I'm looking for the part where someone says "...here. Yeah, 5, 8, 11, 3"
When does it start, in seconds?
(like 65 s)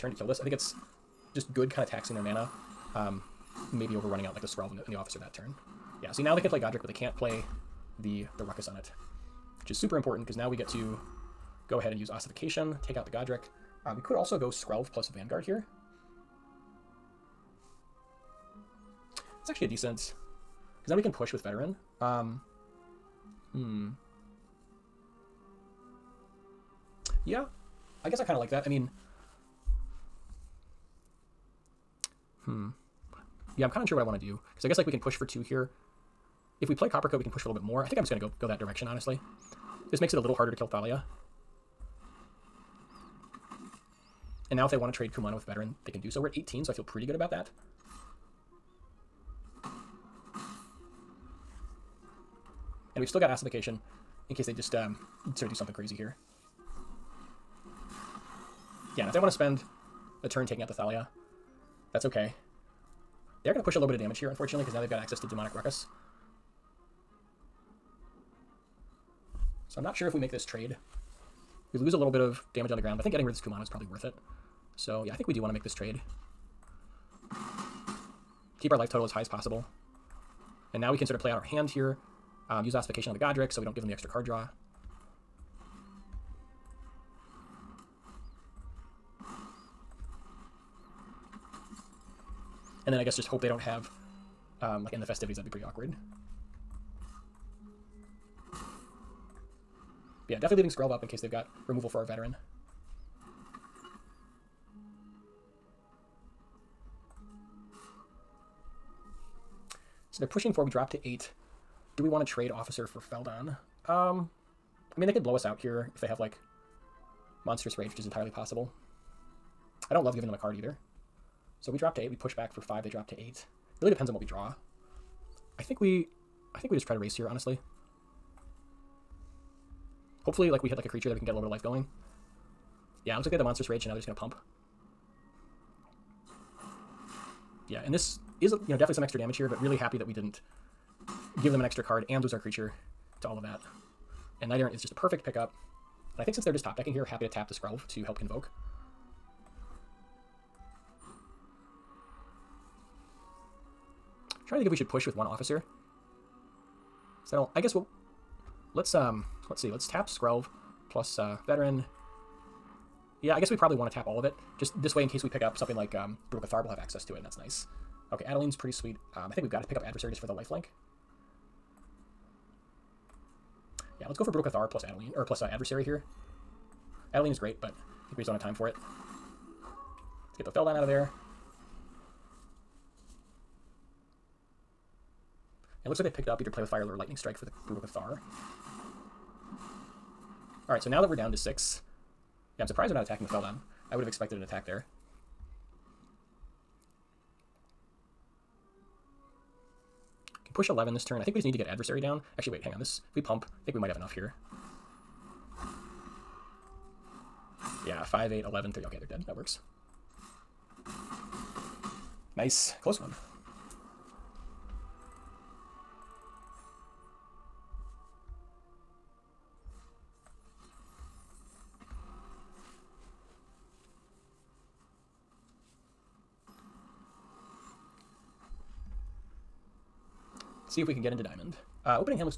204 s.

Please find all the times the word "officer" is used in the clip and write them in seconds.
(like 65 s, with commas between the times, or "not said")
4 s, 112 s, 155 s.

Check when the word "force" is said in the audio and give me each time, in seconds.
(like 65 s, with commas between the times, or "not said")
not said.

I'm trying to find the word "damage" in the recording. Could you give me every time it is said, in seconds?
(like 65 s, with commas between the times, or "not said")
63 s, 72 s, 139 s.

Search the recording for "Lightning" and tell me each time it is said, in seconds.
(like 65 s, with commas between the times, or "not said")
186 s.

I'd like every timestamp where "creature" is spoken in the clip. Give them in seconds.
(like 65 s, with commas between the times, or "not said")
130 s, 142 s.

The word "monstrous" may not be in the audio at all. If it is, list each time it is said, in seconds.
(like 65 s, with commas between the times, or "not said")
117 s, 133 s.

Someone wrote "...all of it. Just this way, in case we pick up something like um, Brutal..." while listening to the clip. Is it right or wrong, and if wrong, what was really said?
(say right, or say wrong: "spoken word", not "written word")
right.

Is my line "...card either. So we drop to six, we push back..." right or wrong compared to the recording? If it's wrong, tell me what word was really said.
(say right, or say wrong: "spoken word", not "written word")
wrong: "eight", not "six".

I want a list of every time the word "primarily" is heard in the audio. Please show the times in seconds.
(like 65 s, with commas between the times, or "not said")
not said.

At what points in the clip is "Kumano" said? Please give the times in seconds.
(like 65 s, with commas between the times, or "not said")
45 s, 73 s.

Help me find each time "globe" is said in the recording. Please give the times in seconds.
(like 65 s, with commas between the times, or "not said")
not said.